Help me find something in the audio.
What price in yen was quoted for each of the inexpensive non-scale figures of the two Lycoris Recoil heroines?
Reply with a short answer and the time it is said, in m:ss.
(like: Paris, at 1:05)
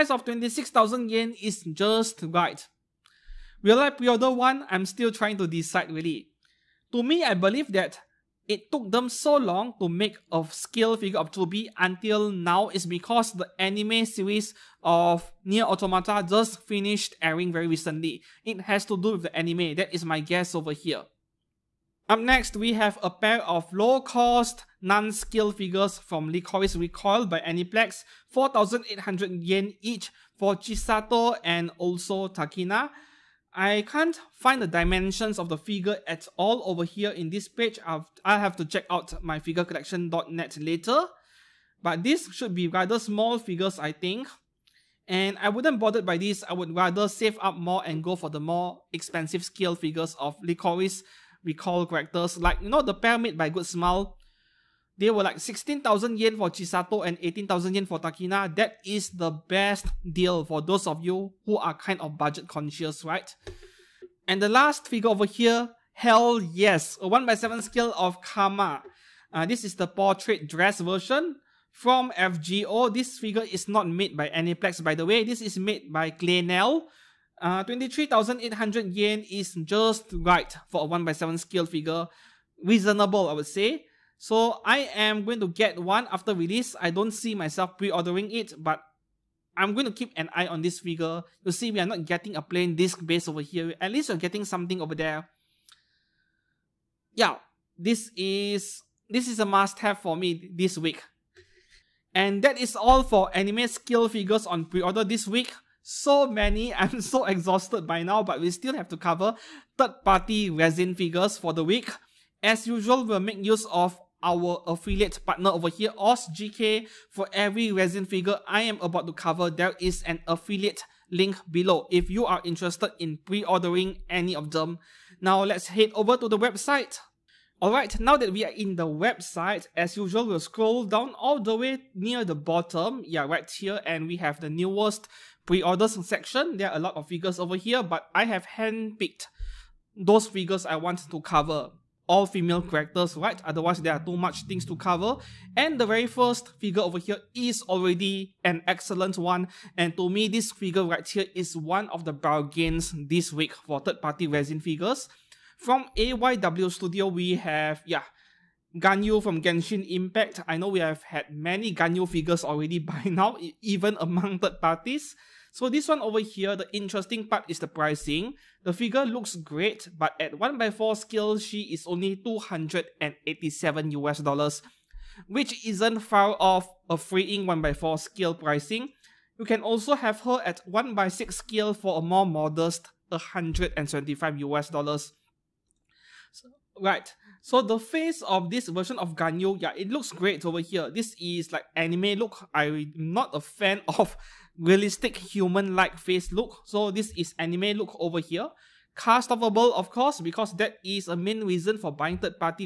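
4,800 yen, at 0:28.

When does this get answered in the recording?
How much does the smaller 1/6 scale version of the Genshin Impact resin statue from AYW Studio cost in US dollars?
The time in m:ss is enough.
3:03.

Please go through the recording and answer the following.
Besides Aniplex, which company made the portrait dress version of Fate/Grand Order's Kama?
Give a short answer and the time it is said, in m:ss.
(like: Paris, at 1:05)
Claynel, at 1:16.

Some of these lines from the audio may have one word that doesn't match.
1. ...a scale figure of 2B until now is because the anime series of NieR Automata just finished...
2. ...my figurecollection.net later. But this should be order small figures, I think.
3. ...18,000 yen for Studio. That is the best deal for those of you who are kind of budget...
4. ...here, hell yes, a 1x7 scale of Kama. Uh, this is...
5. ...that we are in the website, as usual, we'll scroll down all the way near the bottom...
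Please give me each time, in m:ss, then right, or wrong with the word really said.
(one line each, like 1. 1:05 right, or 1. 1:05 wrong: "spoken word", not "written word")
1. 0:10 right
2. 0:39 wrong: "rather", not "order"
3. 0:57 wrong: "Takina", not "Studio"
4. 1:05 right
5. 2:08 right.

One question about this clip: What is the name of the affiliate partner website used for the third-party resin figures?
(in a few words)
OrzGK.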